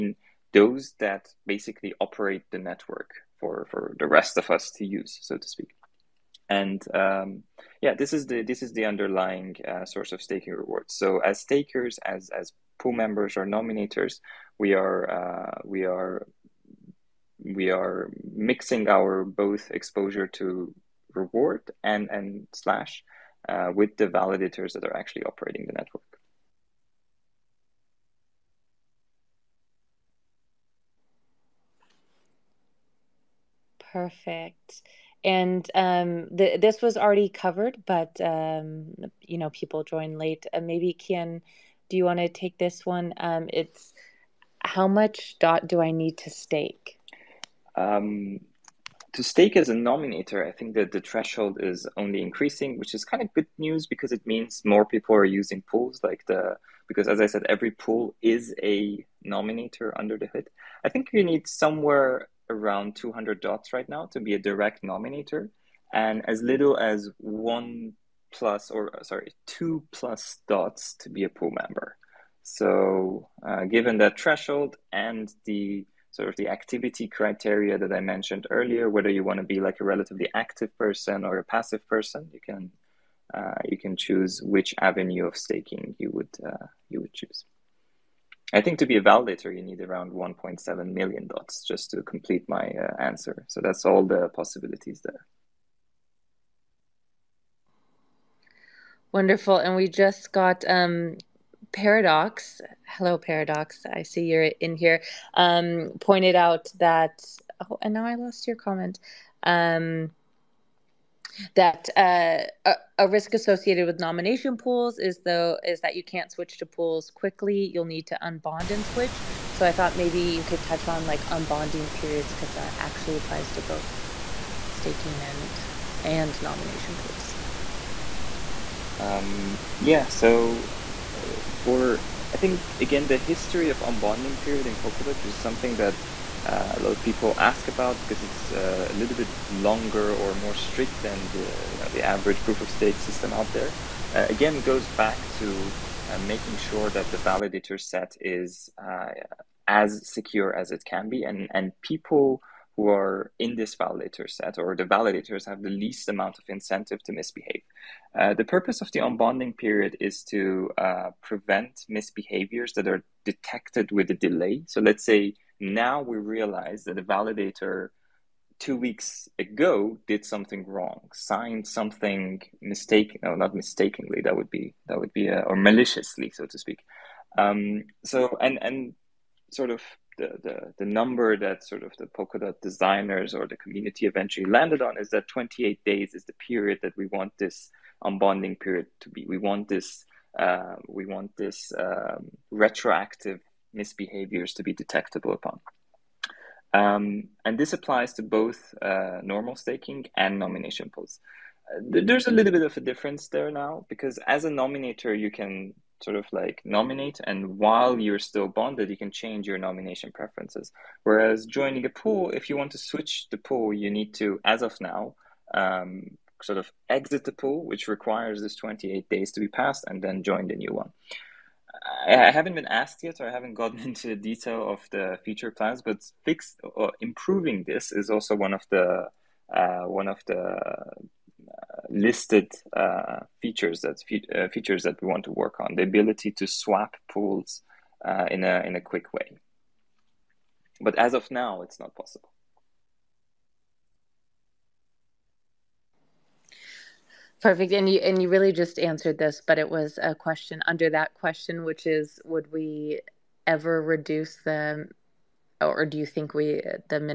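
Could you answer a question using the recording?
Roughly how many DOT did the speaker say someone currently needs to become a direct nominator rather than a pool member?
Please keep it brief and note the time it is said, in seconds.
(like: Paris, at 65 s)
200, at 62 s.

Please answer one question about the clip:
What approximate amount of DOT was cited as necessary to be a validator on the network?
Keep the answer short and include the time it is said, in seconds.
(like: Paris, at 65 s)
1.7 million, at 90 s.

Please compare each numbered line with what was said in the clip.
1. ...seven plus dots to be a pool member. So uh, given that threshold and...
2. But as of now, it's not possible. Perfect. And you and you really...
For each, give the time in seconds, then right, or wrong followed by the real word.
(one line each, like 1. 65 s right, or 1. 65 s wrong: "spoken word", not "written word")
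1. 69 s wrong: "two", not "seven"
2. 240 s right.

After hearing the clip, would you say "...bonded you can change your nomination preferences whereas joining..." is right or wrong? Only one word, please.
right.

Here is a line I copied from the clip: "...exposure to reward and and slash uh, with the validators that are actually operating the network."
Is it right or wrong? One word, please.
right.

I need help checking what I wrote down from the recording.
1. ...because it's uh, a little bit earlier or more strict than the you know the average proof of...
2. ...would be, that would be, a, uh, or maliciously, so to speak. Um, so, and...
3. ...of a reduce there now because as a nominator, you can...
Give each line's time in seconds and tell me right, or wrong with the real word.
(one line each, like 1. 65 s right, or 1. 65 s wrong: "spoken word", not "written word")
1. 138 s wrong: "longer", not "earlier"
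2. 174 s right
3. 202 s wrong: "difference", not "reduce".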